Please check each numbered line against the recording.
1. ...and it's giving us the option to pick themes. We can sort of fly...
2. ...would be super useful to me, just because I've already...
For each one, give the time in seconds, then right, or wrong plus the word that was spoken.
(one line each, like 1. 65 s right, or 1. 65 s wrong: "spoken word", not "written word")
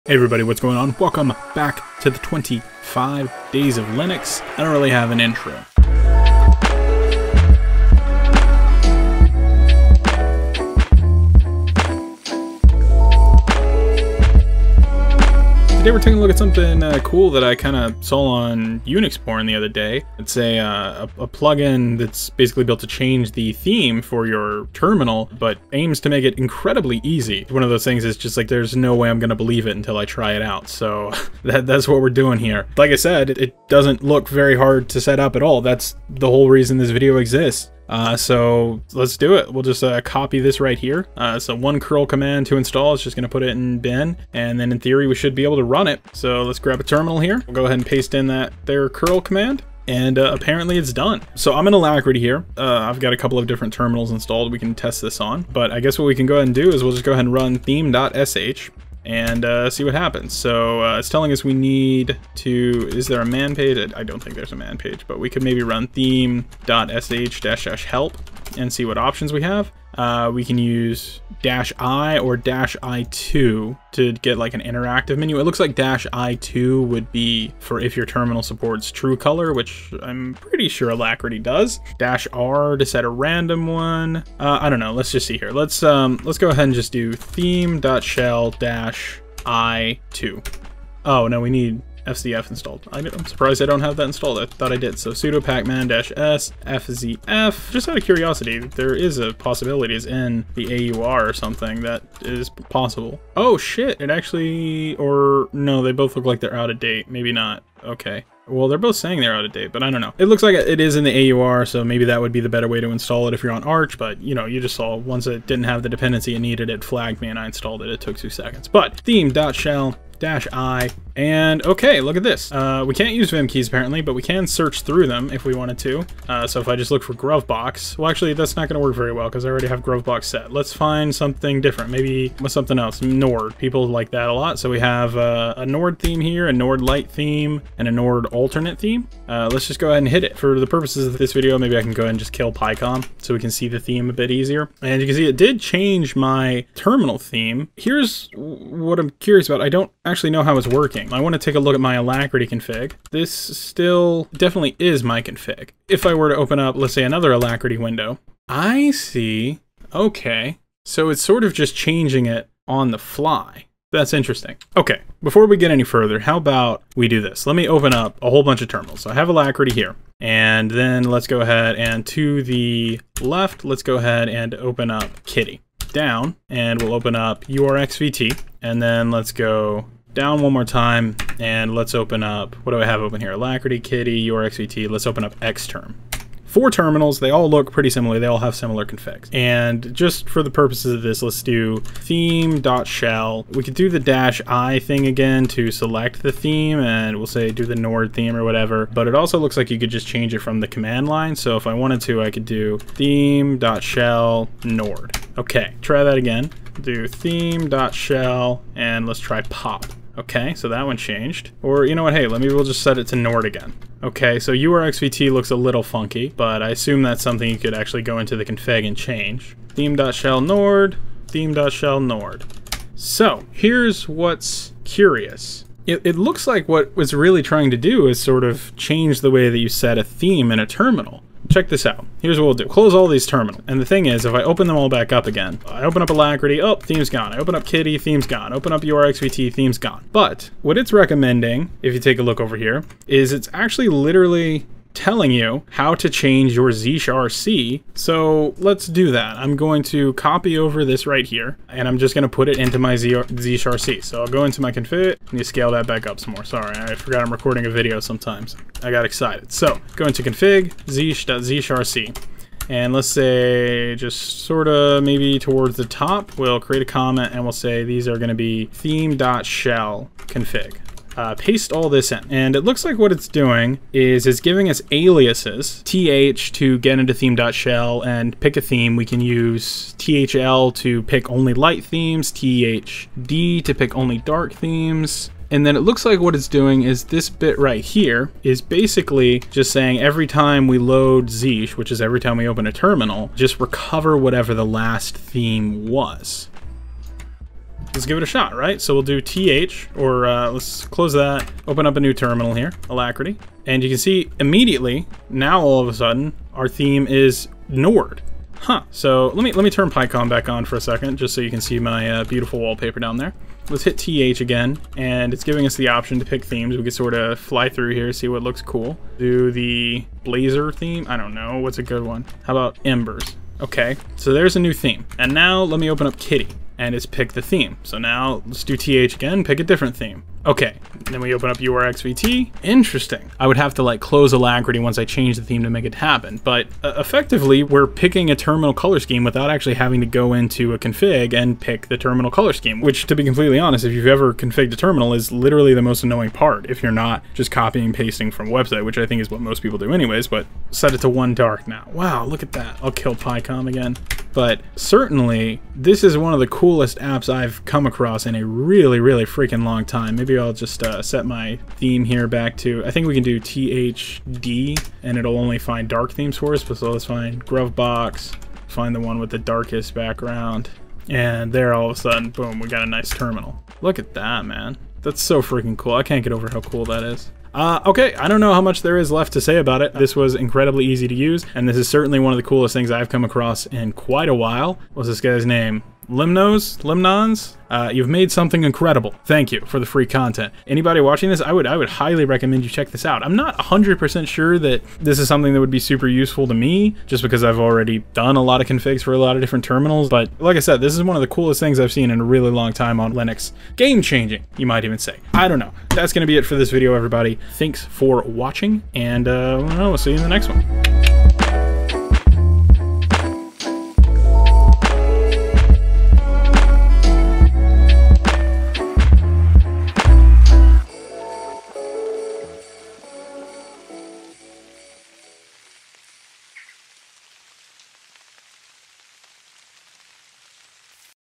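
1. 314 s right
2. 395 s right.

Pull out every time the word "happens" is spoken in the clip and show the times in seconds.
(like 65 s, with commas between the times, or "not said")
59 s, 335 s.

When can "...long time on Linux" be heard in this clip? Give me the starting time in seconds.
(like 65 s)
402 s.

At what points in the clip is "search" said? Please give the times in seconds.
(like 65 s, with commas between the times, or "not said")
124 s.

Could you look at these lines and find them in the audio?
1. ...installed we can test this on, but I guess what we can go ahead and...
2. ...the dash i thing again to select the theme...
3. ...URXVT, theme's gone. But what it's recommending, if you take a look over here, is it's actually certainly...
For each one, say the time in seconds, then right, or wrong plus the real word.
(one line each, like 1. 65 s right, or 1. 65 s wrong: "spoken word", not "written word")
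1. 54 s right
2. 193 s right
3. 238 s wrong: "literally", not "certainly".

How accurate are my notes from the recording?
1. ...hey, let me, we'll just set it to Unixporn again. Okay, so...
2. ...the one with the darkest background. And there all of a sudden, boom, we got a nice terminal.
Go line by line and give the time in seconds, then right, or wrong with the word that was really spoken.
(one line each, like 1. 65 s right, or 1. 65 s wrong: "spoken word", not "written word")
1. 212 s wrong: "Nord", not "Unixporn"
2. 368 s right.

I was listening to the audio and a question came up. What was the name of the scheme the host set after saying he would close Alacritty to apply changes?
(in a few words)
One Dark.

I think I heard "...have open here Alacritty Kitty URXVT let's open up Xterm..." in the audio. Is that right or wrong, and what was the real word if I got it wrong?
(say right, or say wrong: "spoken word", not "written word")
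right.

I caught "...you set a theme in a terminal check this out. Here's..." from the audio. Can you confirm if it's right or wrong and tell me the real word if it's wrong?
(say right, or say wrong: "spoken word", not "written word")
right.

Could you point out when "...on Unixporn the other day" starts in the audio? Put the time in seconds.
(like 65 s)
18 s.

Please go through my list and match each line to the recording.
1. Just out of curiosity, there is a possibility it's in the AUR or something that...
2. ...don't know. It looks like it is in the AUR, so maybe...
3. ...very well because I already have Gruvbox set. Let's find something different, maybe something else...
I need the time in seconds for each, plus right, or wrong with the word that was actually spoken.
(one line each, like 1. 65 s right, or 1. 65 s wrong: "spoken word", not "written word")
1. 97 s right
2. 109 s right
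3. 128 s right.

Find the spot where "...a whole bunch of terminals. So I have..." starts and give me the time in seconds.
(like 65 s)
168 s.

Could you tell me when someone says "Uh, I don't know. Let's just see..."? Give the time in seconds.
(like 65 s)
84 s.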